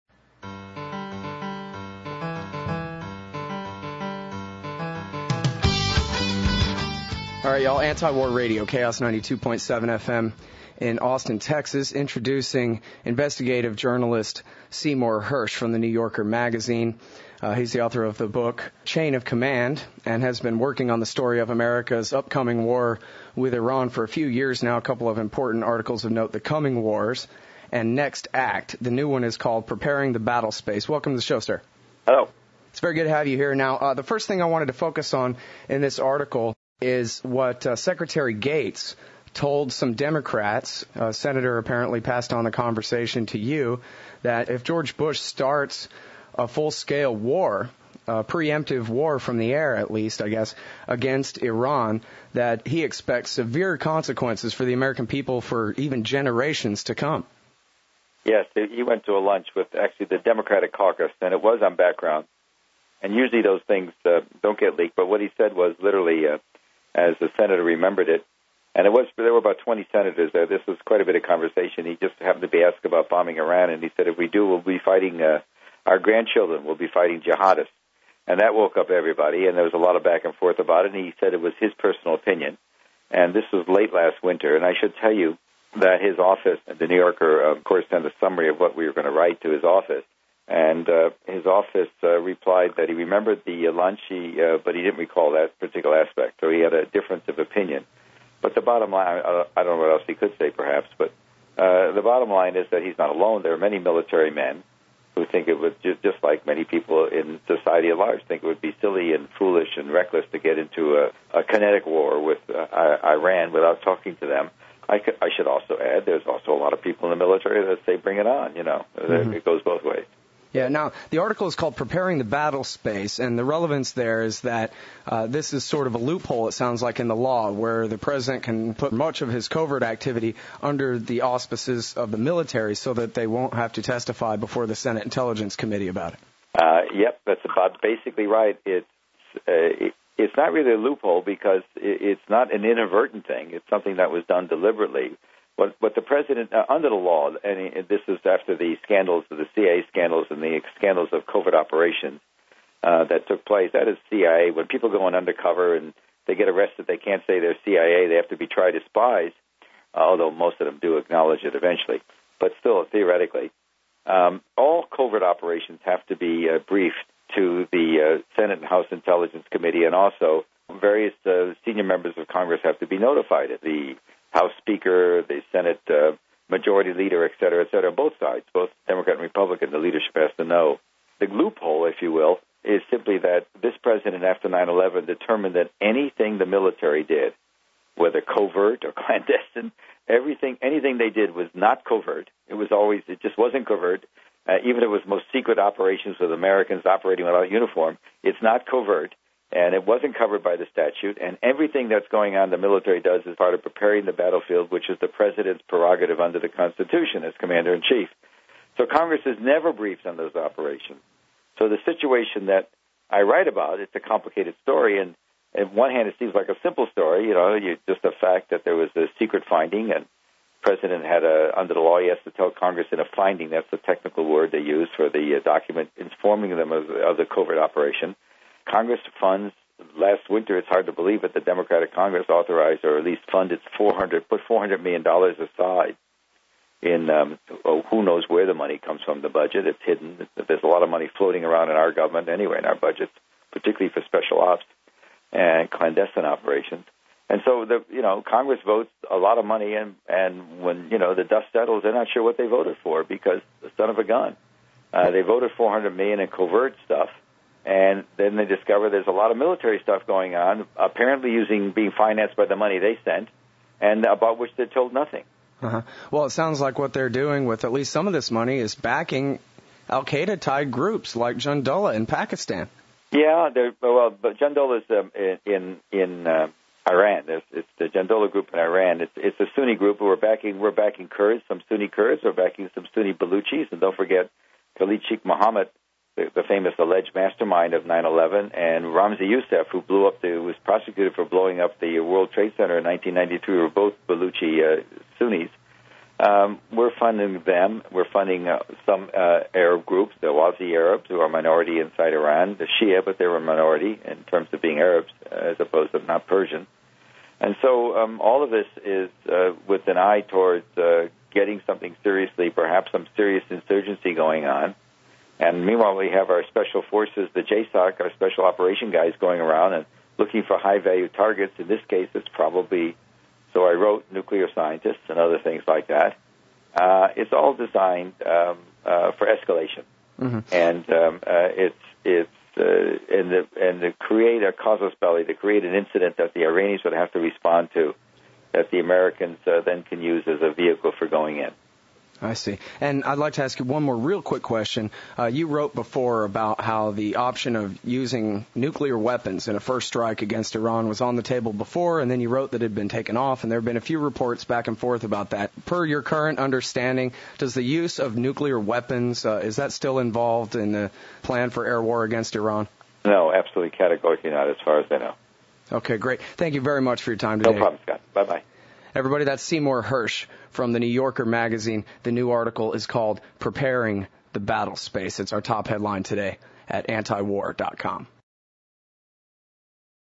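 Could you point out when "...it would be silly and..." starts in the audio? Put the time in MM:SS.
01:48.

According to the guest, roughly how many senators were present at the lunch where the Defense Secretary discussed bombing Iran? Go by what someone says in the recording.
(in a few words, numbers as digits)
20.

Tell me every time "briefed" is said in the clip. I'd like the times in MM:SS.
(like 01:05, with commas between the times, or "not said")
02:46, 03:29.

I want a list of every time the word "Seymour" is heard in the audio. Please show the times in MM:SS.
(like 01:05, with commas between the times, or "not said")
00:14, 06:09.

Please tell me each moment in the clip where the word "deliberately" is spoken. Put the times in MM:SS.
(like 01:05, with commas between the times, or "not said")
02:24.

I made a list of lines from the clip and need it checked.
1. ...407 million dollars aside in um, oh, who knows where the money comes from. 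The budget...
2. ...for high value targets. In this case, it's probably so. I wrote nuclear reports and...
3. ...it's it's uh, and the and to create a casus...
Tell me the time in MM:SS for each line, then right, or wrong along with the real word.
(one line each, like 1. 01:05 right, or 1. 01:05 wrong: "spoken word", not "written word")
1. 03:54 wrong: "400", not "407"
2. 05:20 wrong: "scientists", not "reports"
3. 05:31 right.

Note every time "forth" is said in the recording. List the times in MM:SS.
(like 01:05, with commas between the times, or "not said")
01:20, 05:54.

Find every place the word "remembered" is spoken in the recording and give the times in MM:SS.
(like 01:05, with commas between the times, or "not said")
01:07, 01:32.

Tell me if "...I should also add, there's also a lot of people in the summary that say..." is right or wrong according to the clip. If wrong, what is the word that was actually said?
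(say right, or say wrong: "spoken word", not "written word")
wrong: "military", not "summary".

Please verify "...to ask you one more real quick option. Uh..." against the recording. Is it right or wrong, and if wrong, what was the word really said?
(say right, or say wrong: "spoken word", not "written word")
wrong: "question", not "option".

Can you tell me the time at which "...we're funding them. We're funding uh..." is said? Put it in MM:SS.
04:56.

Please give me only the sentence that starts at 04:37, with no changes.
it's the Jundullah group in Iran.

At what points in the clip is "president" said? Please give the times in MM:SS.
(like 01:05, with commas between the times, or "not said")
02:07, 02:26, 03:03, 03:25, 03:40.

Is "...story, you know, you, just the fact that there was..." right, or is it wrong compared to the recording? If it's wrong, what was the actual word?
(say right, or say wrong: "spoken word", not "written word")
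right.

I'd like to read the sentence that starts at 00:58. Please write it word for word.
Yes, he went to a lunch with actually the Democratic caucus, and it was on background.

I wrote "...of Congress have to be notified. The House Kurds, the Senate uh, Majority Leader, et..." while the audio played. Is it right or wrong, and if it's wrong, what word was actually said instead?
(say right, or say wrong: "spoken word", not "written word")
wrong: "Speaker", not "Kurds".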